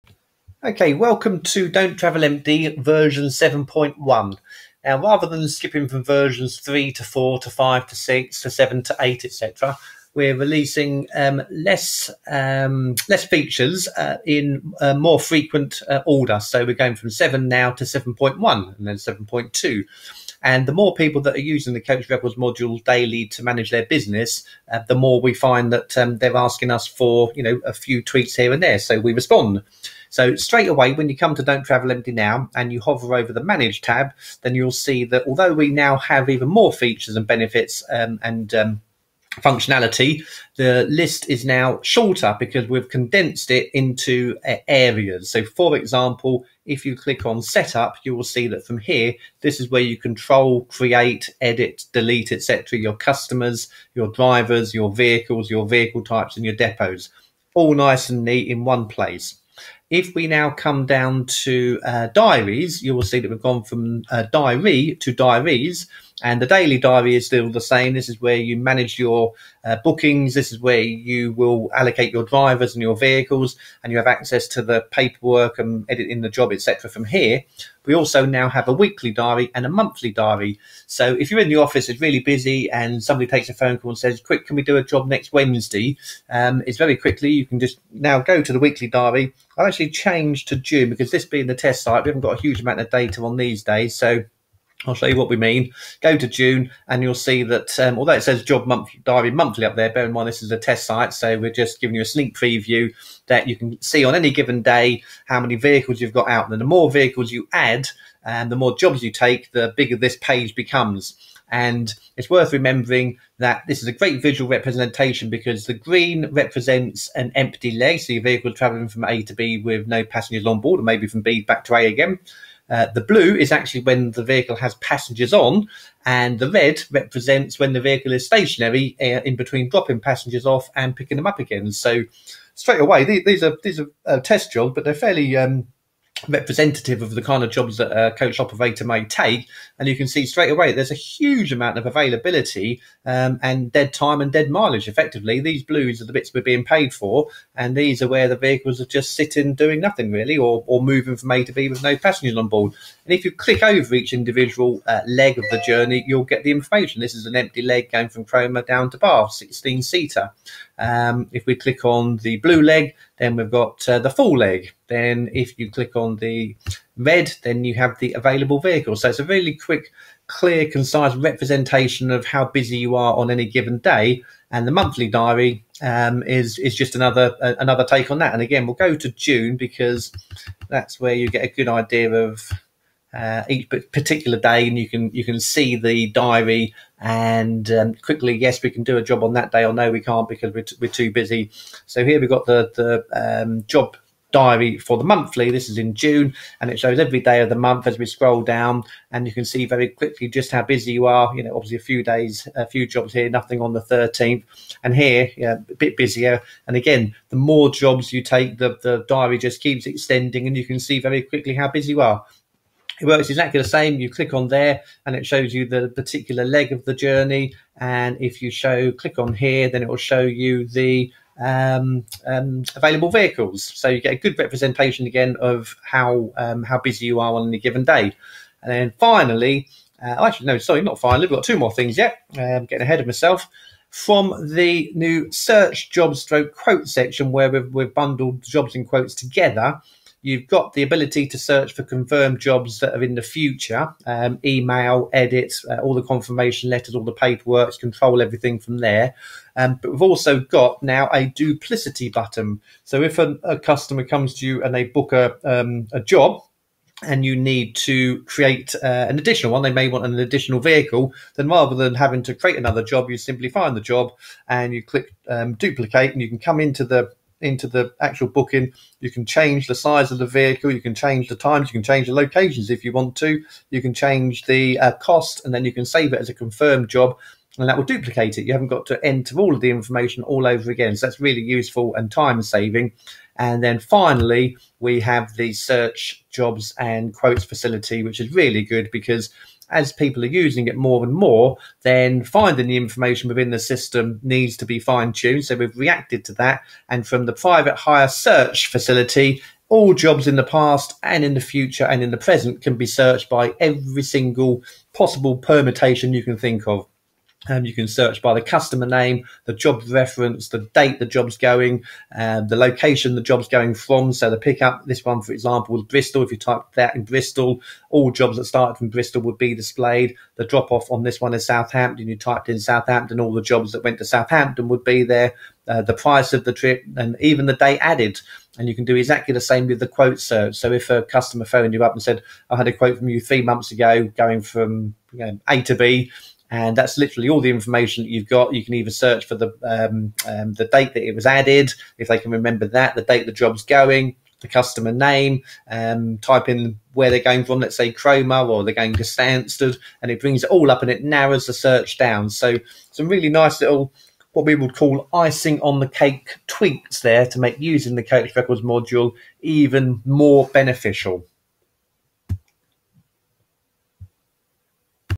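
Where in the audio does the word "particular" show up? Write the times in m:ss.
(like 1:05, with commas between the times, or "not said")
3:03, 3:35.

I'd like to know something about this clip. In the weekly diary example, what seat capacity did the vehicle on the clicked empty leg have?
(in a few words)
16 seater.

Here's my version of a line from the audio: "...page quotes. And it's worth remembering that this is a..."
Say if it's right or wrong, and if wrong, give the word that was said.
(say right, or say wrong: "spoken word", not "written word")
wrong: "becomes", not "quotes".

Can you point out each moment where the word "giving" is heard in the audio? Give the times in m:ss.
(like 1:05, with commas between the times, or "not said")
1:41.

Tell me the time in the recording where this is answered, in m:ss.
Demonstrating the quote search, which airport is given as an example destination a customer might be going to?
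5:49.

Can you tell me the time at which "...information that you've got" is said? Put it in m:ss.
5:37.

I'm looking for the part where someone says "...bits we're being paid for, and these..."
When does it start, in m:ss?
2:26.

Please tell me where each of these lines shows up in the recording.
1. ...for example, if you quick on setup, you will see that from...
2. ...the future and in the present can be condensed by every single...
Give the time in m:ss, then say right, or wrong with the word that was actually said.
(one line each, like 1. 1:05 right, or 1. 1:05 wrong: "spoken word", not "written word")
1. 0:45 wrong: "click", not "quick"
2. 5:01 wrong: "searched", not "condensed".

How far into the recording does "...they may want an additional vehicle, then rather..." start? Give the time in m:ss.
4:19.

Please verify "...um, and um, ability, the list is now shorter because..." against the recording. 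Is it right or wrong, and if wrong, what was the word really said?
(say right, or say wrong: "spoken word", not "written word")
wrong: "functionality", not "ability".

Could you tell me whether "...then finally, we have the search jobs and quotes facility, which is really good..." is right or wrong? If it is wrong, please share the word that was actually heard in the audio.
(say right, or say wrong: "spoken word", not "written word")
right.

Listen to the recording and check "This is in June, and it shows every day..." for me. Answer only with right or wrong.
right.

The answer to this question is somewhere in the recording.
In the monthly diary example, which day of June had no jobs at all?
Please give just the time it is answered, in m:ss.
3:23.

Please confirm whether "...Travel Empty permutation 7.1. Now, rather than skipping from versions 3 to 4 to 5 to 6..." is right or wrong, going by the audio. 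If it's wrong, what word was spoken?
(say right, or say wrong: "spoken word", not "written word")
wrong: "version", not "permutation".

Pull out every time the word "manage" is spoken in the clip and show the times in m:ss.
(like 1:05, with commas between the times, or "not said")
0:23, 0:33, 1:08.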